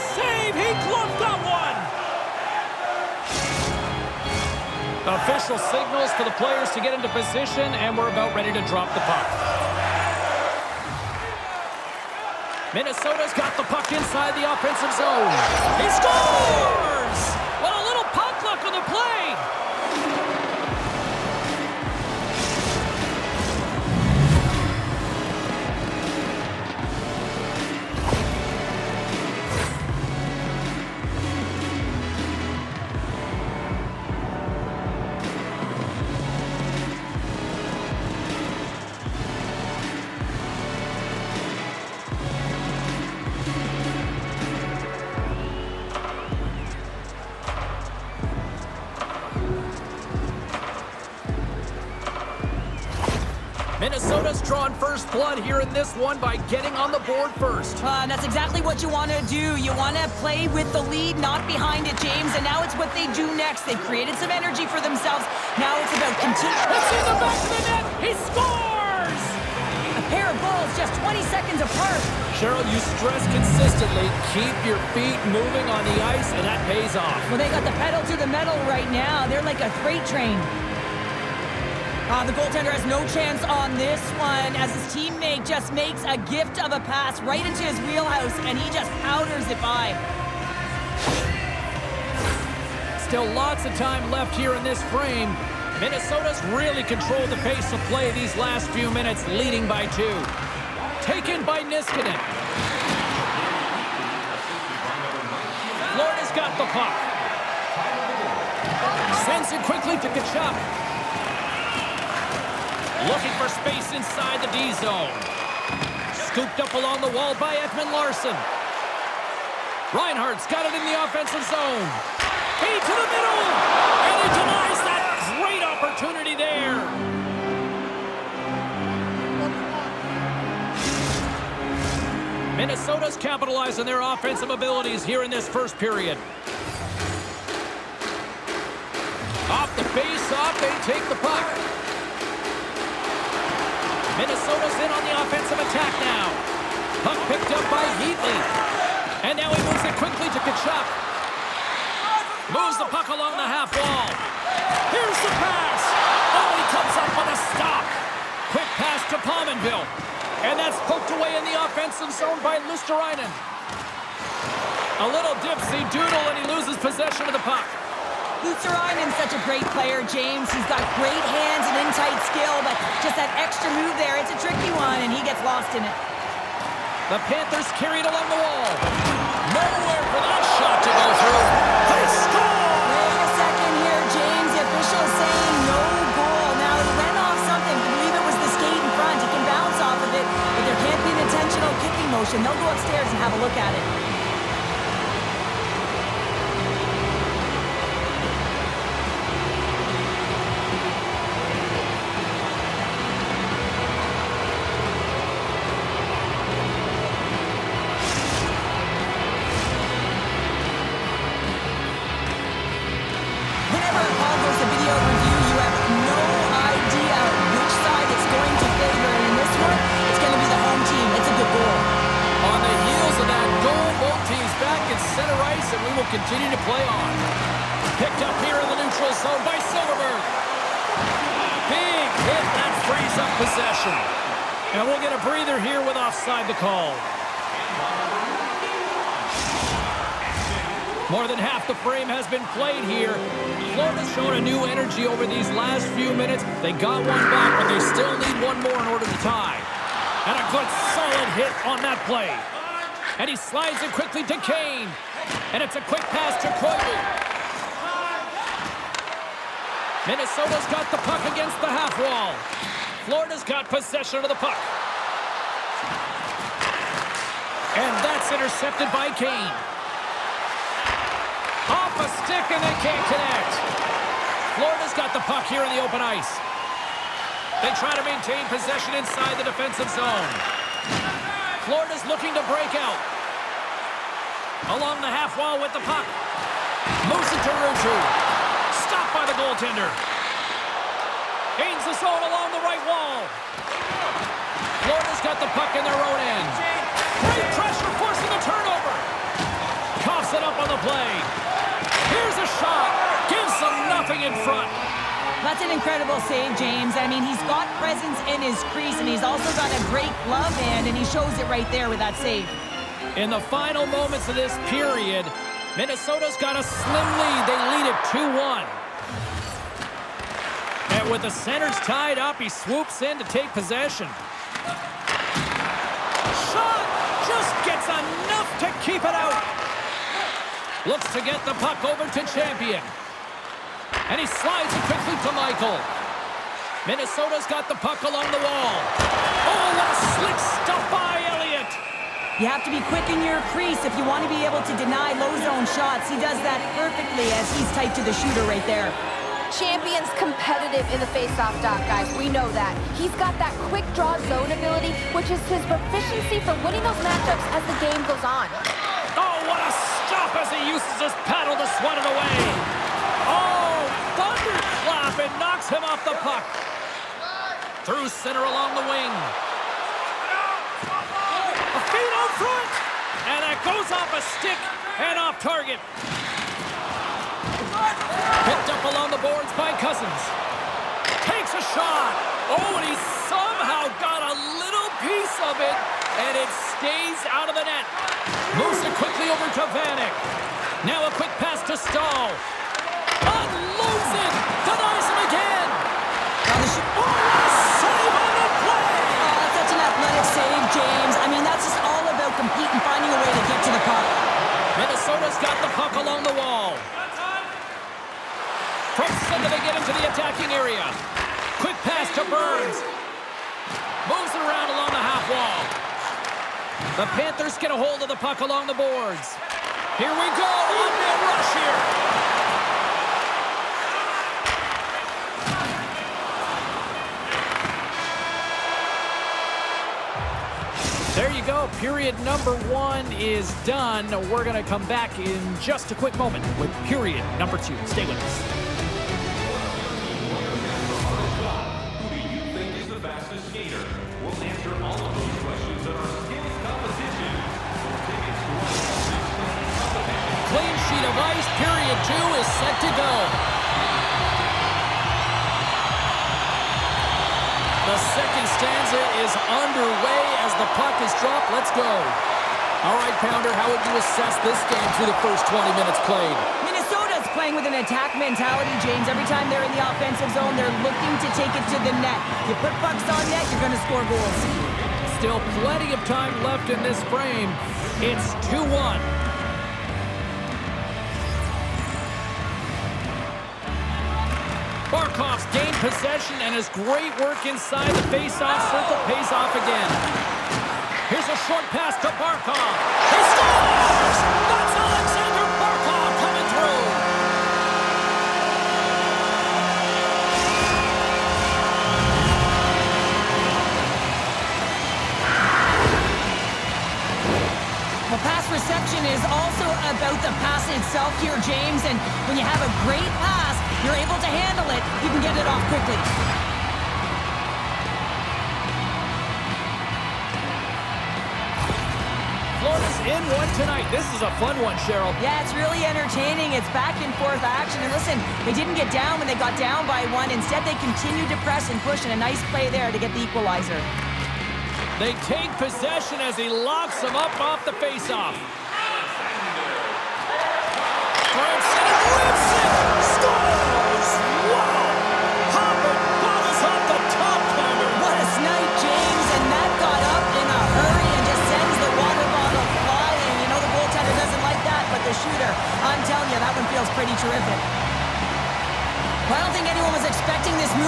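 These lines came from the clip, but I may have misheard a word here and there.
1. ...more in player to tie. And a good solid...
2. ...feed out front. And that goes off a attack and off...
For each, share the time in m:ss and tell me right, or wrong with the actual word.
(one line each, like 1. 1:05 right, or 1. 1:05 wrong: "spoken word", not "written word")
1. 4:08 wrong: "order", not "player"
2. 6:11 wrong: "stick", not "attack".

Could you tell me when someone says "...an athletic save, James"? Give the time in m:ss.
6:39.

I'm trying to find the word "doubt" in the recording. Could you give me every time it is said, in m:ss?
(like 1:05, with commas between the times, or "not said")
not said.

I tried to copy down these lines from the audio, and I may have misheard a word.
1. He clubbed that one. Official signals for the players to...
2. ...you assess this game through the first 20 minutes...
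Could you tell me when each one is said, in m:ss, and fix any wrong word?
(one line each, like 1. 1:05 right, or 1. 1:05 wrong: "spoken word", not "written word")
1. 0:00 right
2. 7:43 right.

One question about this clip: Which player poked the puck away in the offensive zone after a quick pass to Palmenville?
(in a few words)
Luostarinen.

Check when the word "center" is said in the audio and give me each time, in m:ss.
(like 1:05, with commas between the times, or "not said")
5:21, 6:08, 6:49.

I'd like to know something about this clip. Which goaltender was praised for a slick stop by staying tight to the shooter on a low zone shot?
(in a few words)
Elliott.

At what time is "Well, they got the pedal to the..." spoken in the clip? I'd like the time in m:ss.
1:17.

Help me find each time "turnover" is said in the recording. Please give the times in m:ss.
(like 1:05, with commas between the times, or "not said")
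4:58.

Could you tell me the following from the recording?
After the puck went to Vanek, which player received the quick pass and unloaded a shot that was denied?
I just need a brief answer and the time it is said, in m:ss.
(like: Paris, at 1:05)
Stahl, at 6:31.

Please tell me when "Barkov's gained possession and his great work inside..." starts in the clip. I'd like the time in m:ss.
8:04.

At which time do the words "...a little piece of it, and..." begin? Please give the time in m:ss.
6:24.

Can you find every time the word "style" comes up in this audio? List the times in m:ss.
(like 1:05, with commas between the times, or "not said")
not said.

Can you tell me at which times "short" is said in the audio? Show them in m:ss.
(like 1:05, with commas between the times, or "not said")
8:11.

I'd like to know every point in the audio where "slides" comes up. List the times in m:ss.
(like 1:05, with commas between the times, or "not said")
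4:13, 5:34.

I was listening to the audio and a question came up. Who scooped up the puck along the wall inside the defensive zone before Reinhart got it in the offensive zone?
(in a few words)
Edmund Larson.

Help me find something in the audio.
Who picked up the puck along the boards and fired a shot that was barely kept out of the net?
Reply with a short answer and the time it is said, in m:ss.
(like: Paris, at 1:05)
Cousins, at 6:19.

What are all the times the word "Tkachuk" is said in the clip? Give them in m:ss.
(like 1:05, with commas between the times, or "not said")
1:50, 2:30.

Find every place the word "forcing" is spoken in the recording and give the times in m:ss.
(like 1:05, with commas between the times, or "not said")
4:58.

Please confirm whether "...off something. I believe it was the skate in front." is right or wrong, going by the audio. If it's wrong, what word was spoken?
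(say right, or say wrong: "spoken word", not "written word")
right.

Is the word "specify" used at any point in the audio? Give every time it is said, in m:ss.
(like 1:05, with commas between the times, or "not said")
not said.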